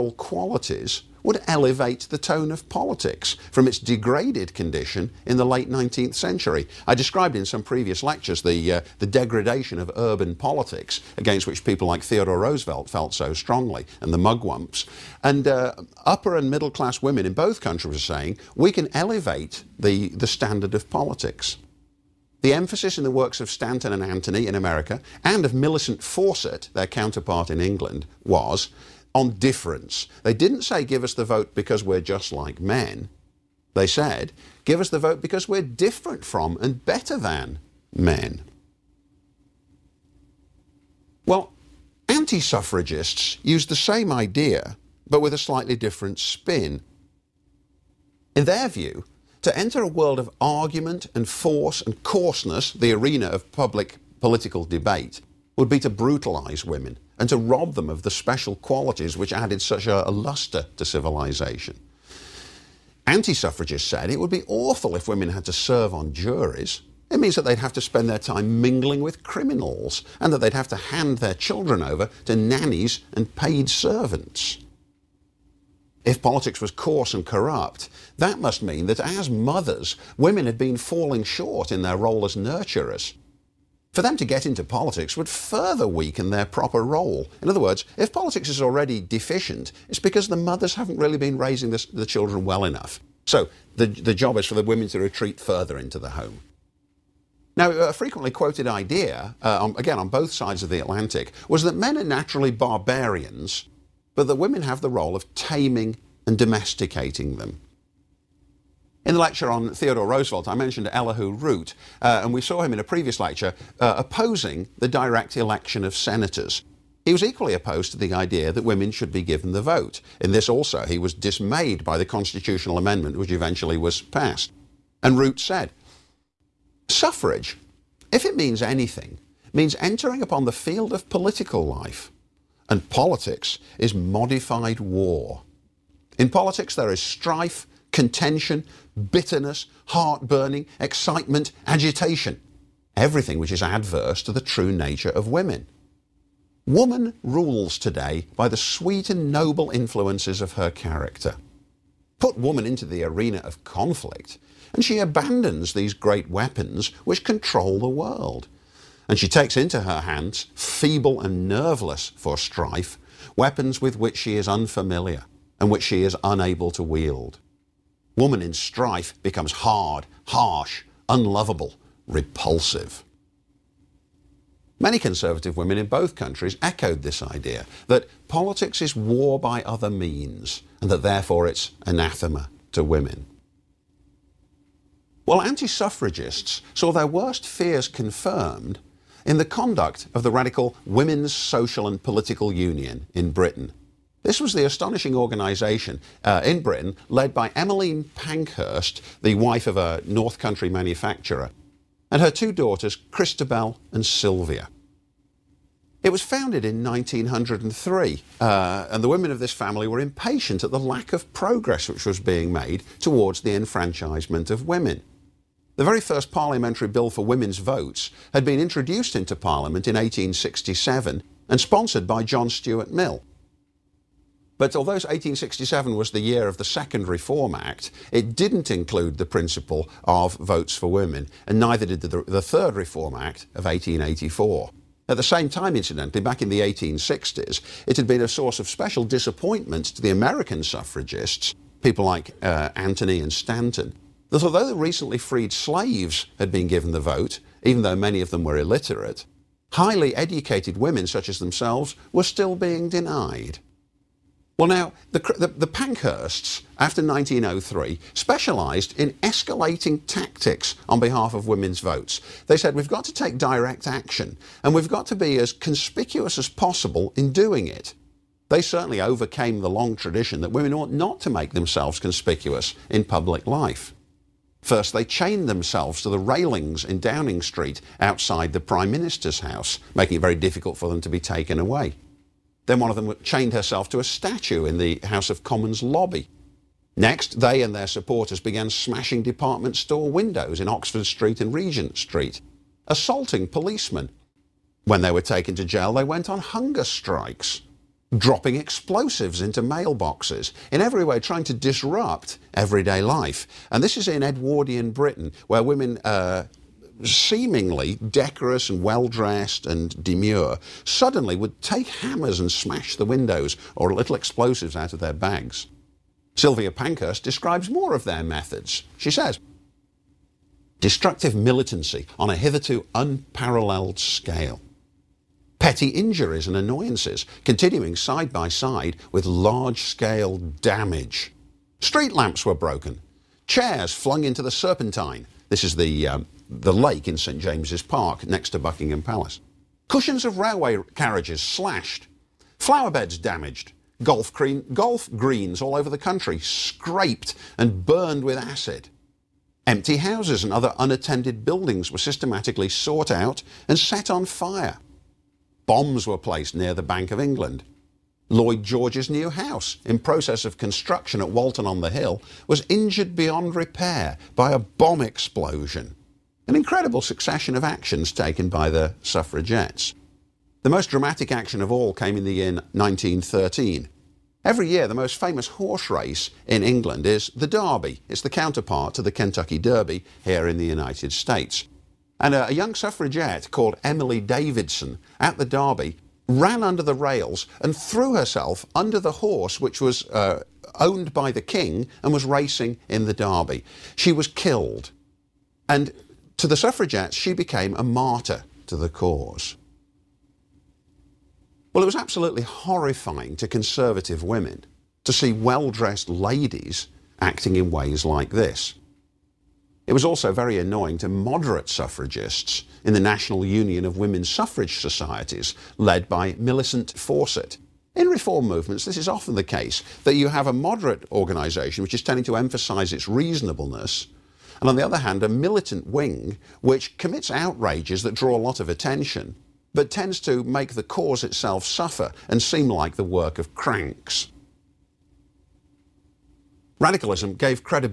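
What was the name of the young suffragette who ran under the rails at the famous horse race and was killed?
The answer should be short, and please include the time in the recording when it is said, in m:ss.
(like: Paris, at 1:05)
Emily Davison, at 6:23.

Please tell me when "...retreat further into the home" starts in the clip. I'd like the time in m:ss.
1:35.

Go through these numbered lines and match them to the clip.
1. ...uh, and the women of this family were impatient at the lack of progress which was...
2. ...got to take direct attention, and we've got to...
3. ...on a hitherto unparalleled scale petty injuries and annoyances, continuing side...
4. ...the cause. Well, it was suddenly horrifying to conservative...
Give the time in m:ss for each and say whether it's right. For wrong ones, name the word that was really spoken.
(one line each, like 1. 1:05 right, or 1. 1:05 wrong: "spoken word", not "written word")
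1. 3:28 right
2. 4:22 wrong: "action", not "attention"
3. 5:22 right
4. 6:38 wrong: "absolutely", not "suddenly".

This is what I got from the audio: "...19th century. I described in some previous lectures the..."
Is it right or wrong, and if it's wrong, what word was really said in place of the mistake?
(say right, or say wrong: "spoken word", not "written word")
right.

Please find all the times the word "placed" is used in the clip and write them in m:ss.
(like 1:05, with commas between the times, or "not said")
5:56.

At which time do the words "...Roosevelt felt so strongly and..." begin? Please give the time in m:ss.
0:12.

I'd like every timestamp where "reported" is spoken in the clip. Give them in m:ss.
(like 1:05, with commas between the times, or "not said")
not said.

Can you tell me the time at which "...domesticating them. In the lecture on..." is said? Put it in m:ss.
1:46.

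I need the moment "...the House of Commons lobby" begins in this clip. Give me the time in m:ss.
4:44.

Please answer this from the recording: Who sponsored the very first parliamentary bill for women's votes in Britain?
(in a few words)
John Stuart Mill.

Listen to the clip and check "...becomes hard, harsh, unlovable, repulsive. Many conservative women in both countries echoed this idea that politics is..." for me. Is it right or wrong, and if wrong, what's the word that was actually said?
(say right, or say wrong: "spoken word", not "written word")
right.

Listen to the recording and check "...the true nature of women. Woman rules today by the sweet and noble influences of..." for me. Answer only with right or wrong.
right.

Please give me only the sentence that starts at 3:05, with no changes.
While anti suffragists saw their worst fears confirmed in the conduct of the radical Women's Social and Political Union in Britain.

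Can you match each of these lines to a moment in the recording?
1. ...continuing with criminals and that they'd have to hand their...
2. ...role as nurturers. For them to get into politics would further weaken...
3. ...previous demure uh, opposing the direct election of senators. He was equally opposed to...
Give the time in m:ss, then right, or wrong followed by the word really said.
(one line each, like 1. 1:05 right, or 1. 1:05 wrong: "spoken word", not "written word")
1. 1:08 wrong: "mingling", not "continuing"
2. 1:21 right
3. 1:52 wrong: "lecture", not "demure".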